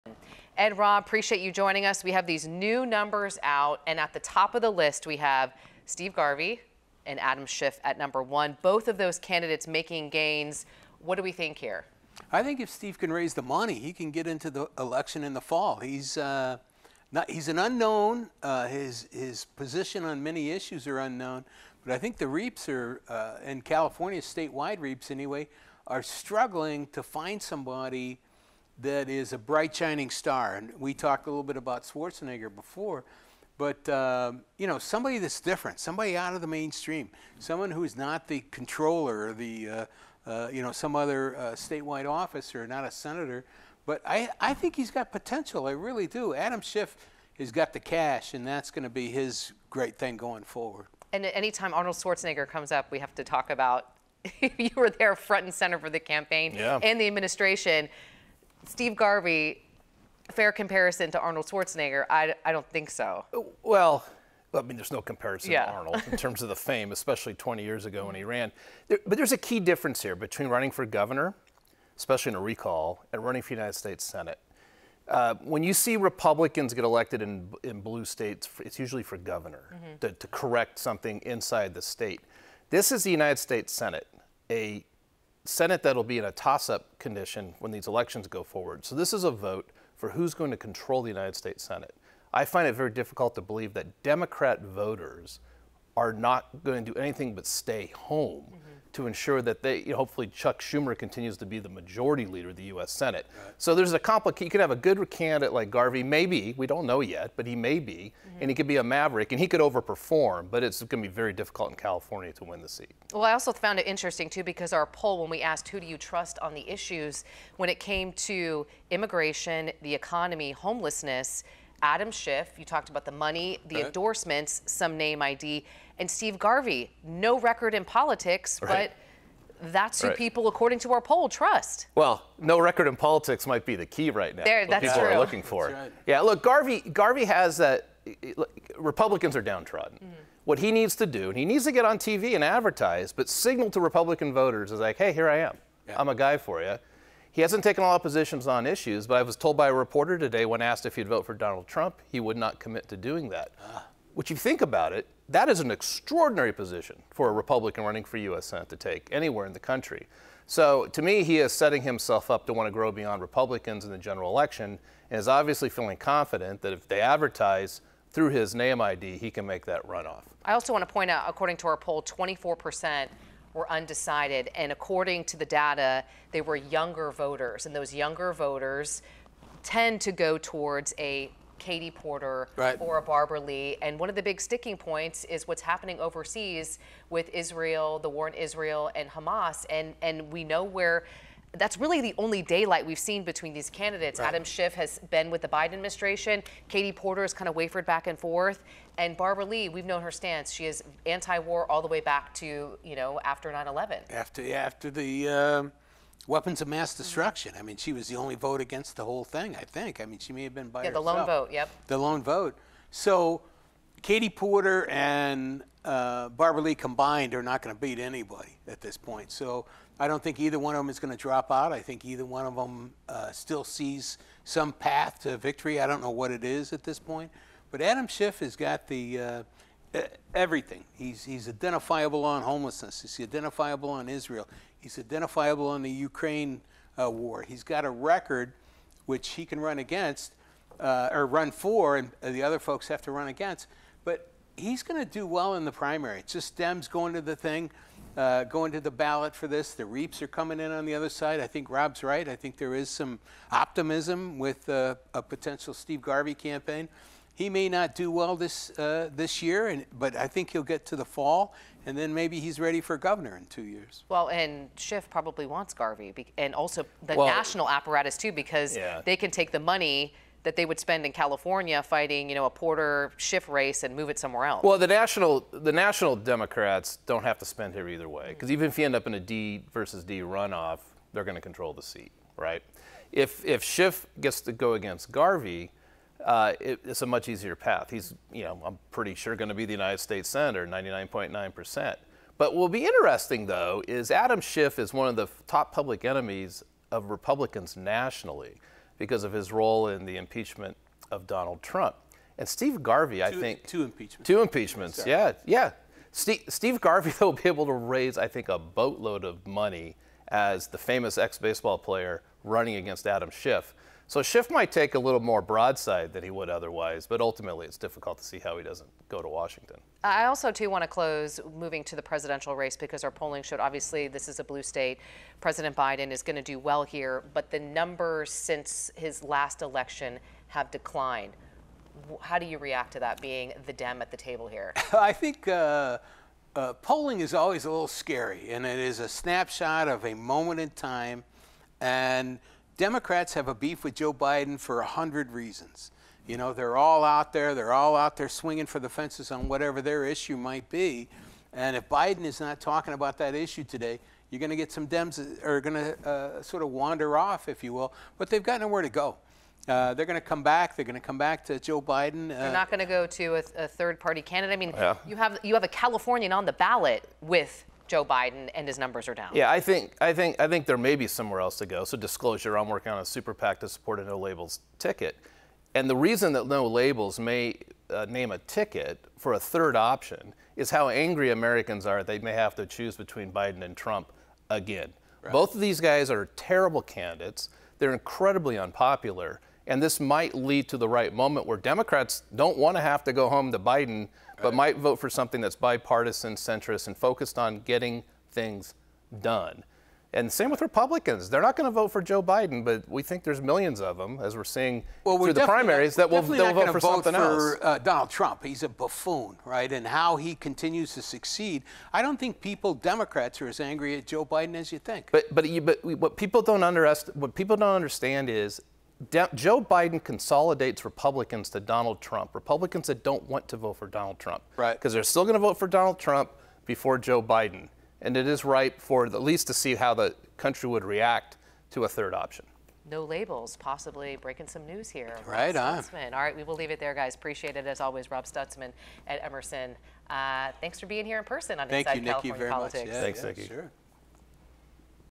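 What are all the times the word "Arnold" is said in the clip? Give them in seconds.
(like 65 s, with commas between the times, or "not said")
51 s, 61 s, 65 s.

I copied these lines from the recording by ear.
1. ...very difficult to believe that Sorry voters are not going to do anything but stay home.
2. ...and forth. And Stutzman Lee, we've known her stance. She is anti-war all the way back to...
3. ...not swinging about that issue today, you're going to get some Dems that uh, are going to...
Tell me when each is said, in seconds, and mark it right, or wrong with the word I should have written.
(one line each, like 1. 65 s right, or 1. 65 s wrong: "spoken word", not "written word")
1. 92 s wrong: "Democrat", not "Sorry"
2. 198 s wrong: "Barbara", not "Stutzman"
3. 352 s wrong: "talking", not "swinging".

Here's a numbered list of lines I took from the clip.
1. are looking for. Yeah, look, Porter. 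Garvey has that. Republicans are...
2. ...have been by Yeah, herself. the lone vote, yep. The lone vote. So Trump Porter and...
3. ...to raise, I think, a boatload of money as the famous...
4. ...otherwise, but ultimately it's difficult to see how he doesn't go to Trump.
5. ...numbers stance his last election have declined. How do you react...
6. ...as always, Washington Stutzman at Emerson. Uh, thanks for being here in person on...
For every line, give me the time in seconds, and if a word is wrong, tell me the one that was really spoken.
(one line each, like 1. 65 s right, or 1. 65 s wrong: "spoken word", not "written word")
1. 135 s wrong: "Garvey", not "Porter"
2. 210 s wrong: "Katie", not "Trump"
3. 307 s right
4. 316 s wrong: "Washington", not "Trump"
5. 327 s wrong: "since", not "stance"
6. 437 s wrong: "Rob", not "Washington".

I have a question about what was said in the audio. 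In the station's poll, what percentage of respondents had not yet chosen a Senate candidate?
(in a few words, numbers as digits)
24 percent.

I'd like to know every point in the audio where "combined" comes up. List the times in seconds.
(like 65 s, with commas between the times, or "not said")
216 s.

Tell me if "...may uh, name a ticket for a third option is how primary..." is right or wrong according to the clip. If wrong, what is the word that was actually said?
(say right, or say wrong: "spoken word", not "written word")
wrong: "angry", not "primary".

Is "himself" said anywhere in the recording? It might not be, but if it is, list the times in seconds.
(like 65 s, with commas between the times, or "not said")
161 s.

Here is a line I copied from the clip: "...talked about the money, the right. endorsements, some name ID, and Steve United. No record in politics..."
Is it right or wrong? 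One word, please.
wrong.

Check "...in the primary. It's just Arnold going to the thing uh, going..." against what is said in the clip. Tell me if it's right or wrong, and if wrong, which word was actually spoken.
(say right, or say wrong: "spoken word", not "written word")
wrong: "Dems", not "Arnold".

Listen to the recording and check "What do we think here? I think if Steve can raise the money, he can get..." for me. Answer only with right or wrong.
right.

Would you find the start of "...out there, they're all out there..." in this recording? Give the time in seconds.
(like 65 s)
347 s.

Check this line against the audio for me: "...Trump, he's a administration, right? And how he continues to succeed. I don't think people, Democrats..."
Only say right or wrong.
wrong.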